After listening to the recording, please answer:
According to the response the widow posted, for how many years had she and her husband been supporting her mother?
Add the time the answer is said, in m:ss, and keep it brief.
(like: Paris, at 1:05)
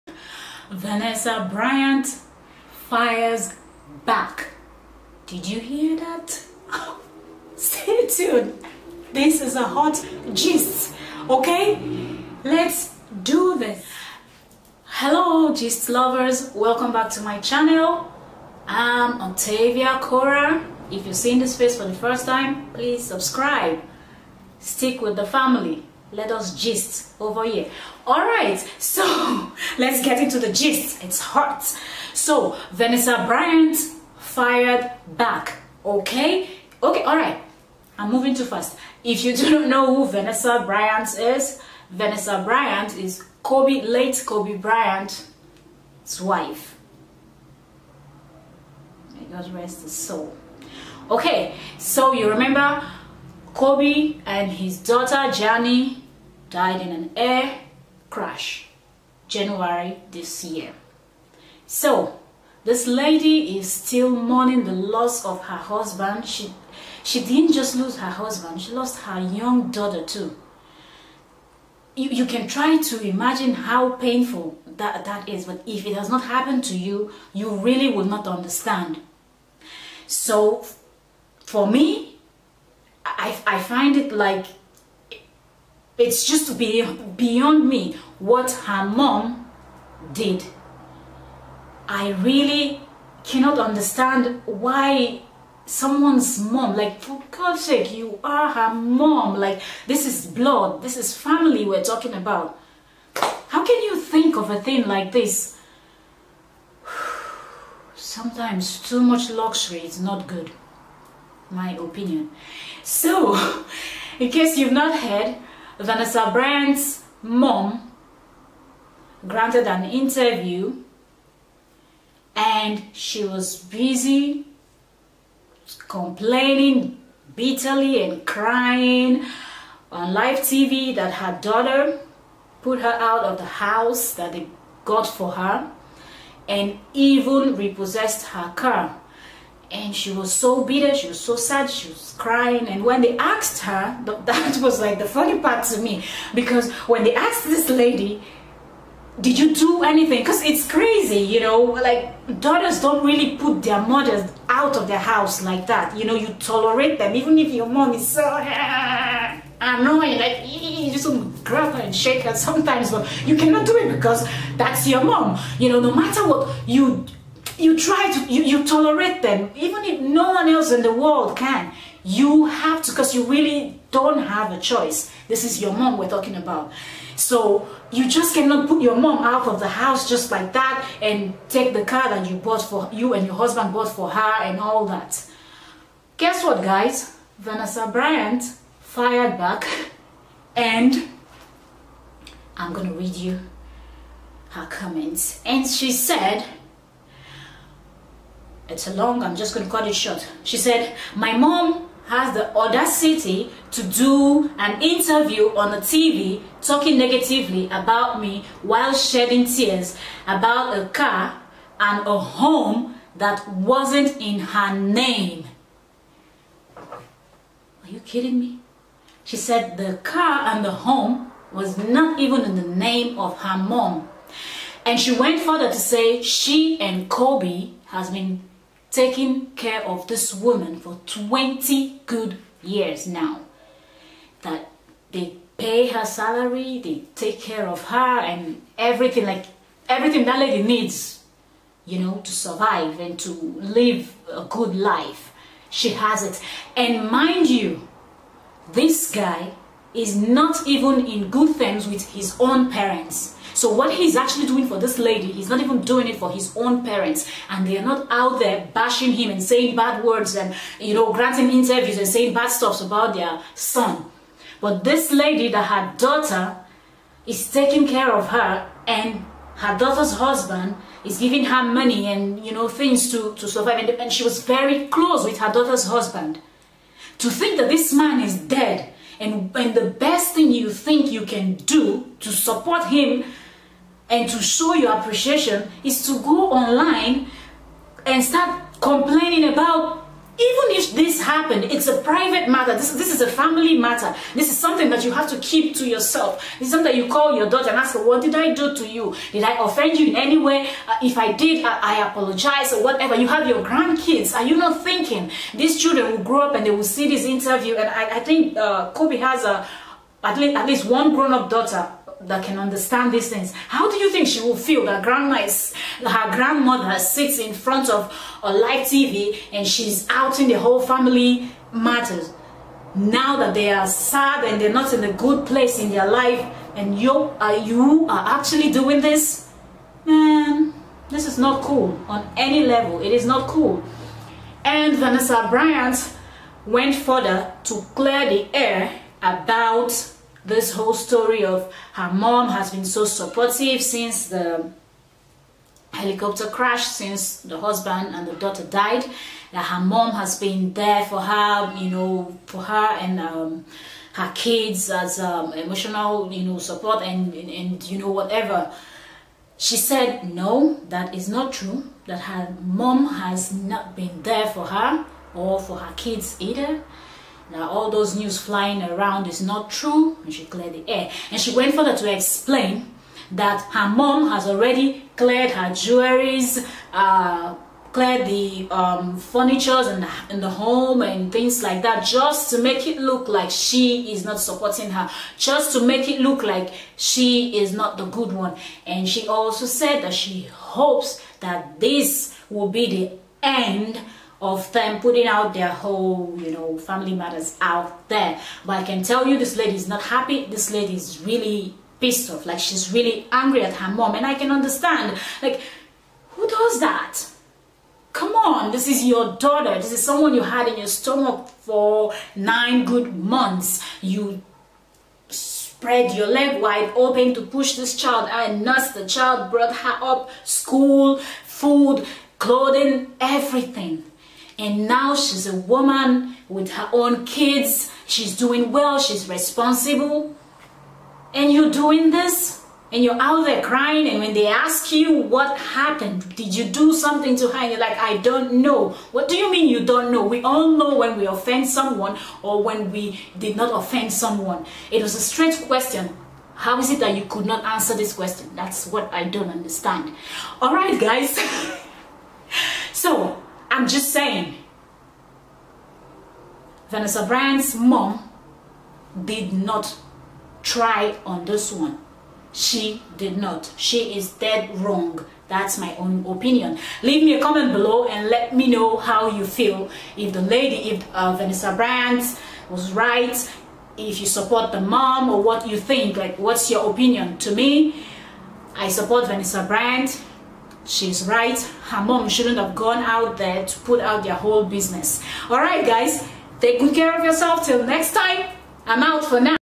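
20, at 3:51.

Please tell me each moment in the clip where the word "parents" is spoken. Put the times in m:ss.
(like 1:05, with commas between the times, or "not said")
4:12, 4:16.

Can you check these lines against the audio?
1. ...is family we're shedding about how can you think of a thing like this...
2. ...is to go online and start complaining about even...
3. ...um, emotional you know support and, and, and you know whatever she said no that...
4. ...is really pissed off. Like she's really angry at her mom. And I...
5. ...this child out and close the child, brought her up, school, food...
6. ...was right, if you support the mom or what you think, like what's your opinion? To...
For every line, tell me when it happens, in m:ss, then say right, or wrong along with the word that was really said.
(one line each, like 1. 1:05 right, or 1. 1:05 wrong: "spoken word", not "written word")
1. 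1:40 wrong: "talking", not "shedding"
2. 4:45 right
3. 5:55 right
4. 6:40 right
5. 6:57 wrong: "nurse", not "close"
6. 7:52 right.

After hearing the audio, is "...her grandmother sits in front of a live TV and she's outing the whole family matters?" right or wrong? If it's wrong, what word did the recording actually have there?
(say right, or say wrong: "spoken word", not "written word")
right.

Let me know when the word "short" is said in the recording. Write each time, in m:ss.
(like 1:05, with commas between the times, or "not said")
3:19.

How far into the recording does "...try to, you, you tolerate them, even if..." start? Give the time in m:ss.
2:47.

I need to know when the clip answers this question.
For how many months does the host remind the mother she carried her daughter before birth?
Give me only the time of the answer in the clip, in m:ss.
6:52.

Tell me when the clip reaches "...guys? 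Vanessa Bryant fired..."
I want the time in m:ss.
3:06.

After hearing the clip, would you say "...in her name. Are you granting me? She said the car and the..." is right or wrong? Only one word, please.
wrong.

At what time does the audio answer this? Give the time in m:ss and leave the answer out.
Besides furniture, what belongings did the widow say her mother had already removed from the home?
6:15.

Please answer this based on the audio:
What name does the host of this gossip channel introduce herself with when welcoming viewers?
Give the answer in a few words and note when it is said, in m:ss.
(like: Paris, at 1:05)
Octavia Kora, at 0:19.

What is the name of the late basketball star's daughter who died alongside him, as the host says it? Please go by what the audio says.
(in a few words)
Jani.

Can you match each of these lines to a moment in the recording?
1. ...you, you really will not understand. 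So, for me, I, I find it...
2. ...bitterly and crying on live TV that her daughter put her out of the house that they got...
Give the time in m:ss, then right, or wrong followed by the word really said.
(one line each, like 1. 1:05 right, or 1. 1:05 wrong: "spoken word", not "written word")
1. 1:16 right
2. 2:07 right.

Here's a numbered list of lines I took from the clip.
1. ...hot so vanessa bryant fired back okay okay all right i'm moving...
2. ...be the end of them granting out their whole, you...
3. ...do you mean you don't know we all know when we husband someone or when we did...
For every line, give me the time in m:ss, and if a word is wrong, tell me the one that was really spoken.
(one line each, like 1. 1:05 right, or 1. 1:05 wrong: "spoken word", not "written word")
1. 0:31 right
2. 6:32 wrong: "putting", not "granting"
3. 7:19 wrong: "offend", not "husband".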